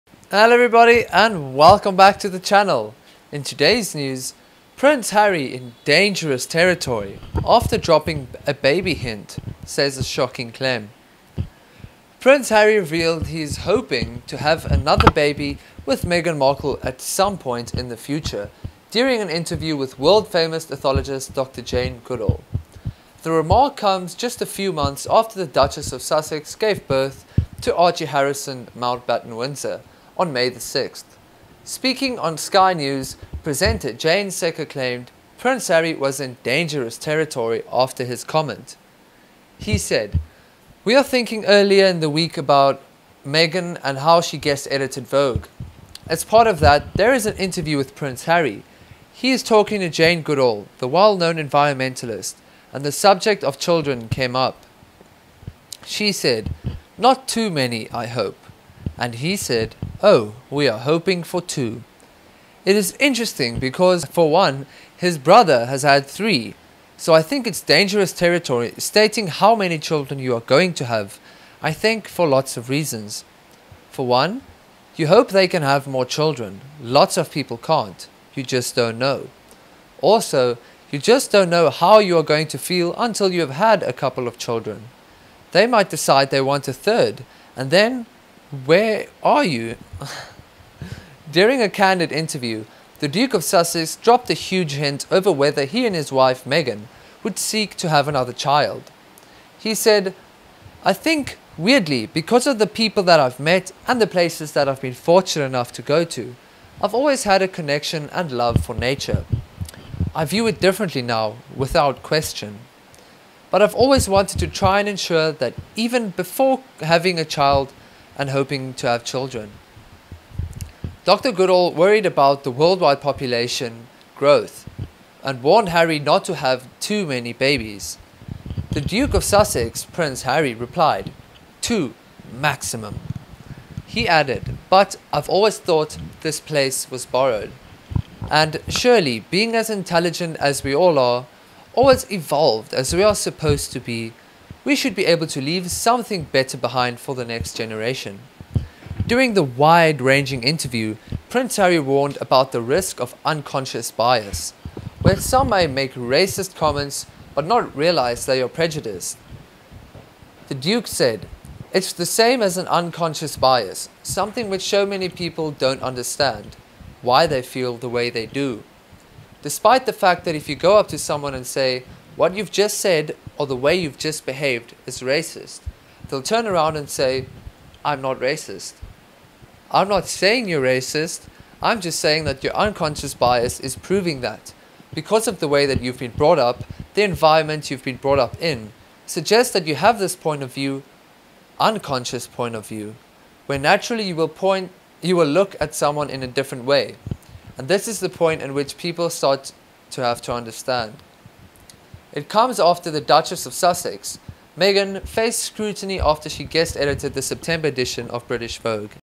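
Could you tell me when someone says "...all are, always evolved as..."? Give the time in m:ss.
2:20.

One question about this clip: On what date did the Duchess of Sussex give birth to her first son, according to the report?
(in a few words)
May 6.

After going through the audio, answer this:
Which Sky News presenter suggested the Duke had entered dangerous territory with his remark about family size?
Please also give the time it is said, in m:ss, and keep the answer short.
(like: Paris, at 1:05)
Jayne Secker, at 0:33.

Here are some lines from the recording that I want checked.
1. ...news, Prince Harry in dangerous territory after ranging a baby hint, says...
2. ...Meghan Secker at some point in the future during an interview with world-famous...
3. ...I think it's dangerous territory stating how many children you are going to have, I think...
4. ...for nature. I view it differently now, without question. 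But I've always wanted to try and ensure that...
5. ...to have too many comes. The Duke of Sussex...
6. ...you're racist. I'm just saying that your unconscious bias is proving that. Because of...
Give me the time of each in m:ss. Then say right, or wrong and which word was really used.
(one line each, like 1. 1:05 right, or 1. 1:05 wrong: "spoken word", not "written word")
1. 0:03 wrong: "dropping", not "ranging"
2. 0:16 wrong: "Markle", not "Secker"
3. 1:07 right
4. 1:48 right
5. 2:06 wrong: "babies", not "comes"
6. 3:00 right.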